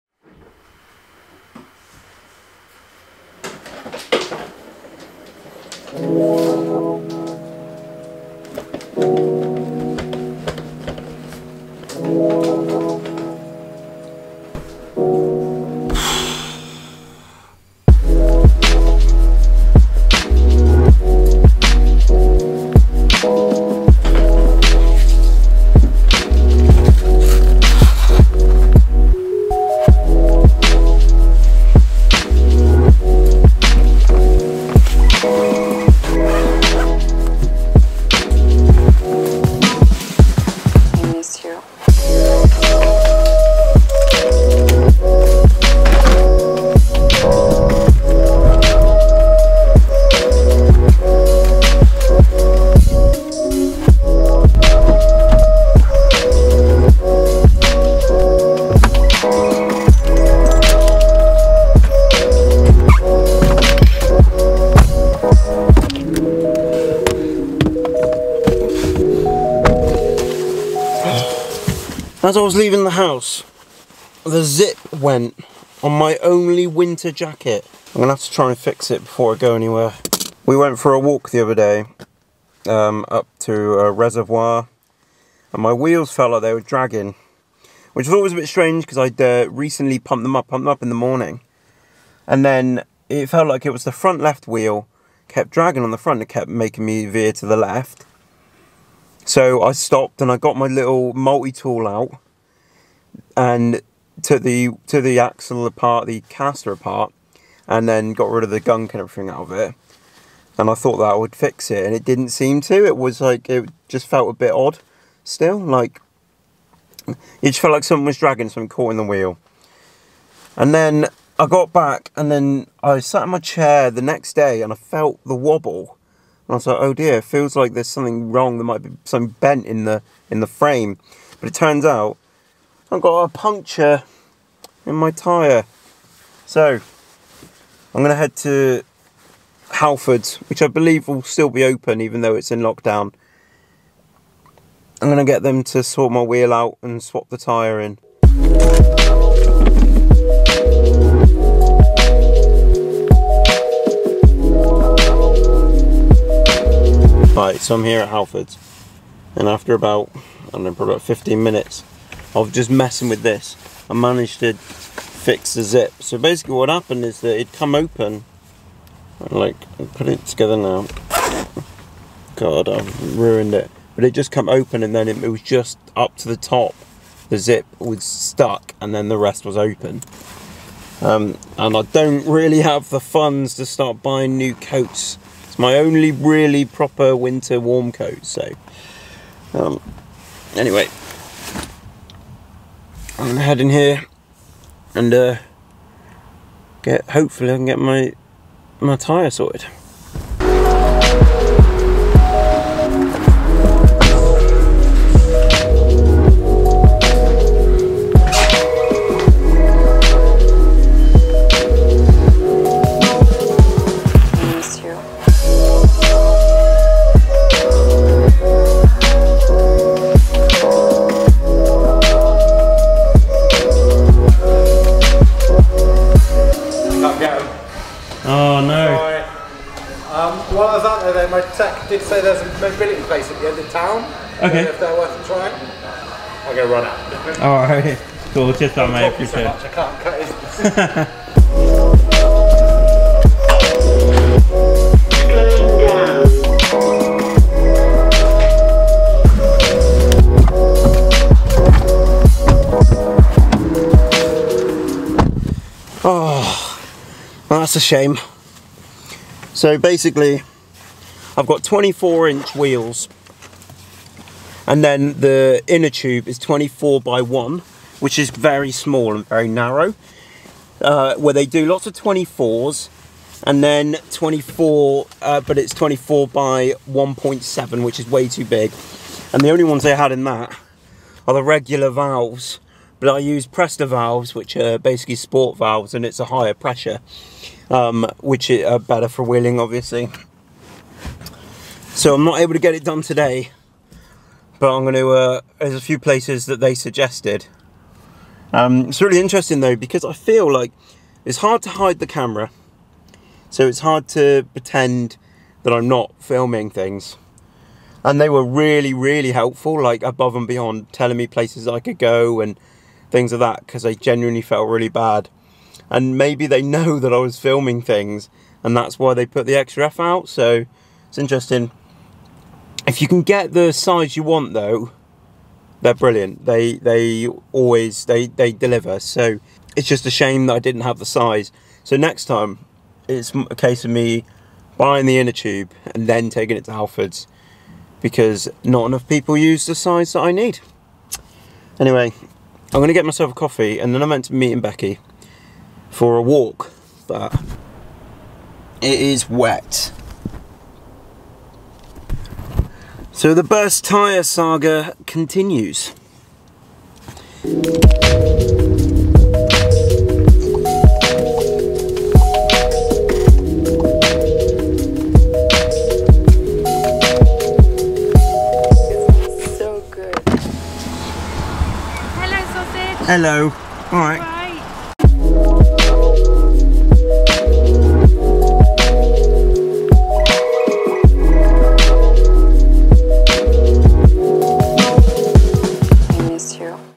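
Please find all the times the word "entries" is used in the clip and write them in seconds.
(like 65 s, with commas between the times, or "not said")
not said.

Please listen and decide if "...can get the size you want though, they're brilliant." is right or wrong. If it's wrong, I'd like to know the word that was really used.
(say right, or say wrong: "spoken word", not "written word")
right.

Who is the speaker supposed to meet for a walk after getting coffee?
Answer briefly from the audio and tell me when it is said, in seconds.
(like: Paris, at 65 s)
Becky, at 344 s.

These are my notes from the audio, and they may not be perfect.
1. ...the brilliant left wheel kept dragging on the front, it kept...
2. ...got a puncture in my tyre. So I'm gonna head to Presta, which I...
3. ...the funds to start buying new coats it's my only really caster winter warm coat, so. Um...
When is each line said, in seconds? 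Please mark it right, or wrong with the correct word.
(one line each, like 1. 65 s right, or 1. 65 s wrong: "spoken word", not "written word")
1. 93 s wrong: "front", not "brilliant"
2. 132 s wrong: "Halfords", not "Presta"
3. 182 s wrong: "proper", not "caster".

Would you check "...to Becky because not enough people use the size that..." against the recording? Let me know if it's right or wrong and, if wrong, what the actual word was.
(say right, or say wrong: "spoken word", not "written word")
wrong: "Halfords", not "Becky".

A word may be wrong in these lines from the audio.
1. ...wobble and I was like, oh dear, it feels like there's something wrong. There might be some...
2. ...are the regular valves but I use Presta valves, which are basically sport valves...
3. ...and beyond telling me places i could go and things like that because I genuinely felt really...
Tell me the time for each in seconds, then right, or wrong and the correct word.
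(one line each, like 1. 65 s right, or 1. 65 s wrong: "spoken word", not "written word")
1. 125 s right
2. 281 s right
3. 310 s right.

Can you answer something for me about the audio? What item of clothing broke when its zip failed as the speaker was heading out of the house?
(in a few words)
winter jacket.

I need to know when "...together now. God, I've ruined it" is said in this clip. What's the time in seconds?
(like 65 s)
170 s.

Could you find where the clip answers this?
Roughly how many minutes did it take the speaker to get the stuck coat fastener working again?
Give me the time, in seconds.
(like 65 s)
161 s.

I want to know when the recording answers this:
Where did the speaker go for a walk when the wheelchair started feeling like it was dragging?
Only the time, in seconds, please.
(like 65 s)
83 s.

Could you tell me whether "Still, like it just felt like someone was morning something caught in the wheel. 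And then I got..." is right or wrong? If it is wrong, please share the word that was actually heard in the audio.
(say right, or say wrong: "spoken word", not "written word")
wrong: "dragging", not "morning".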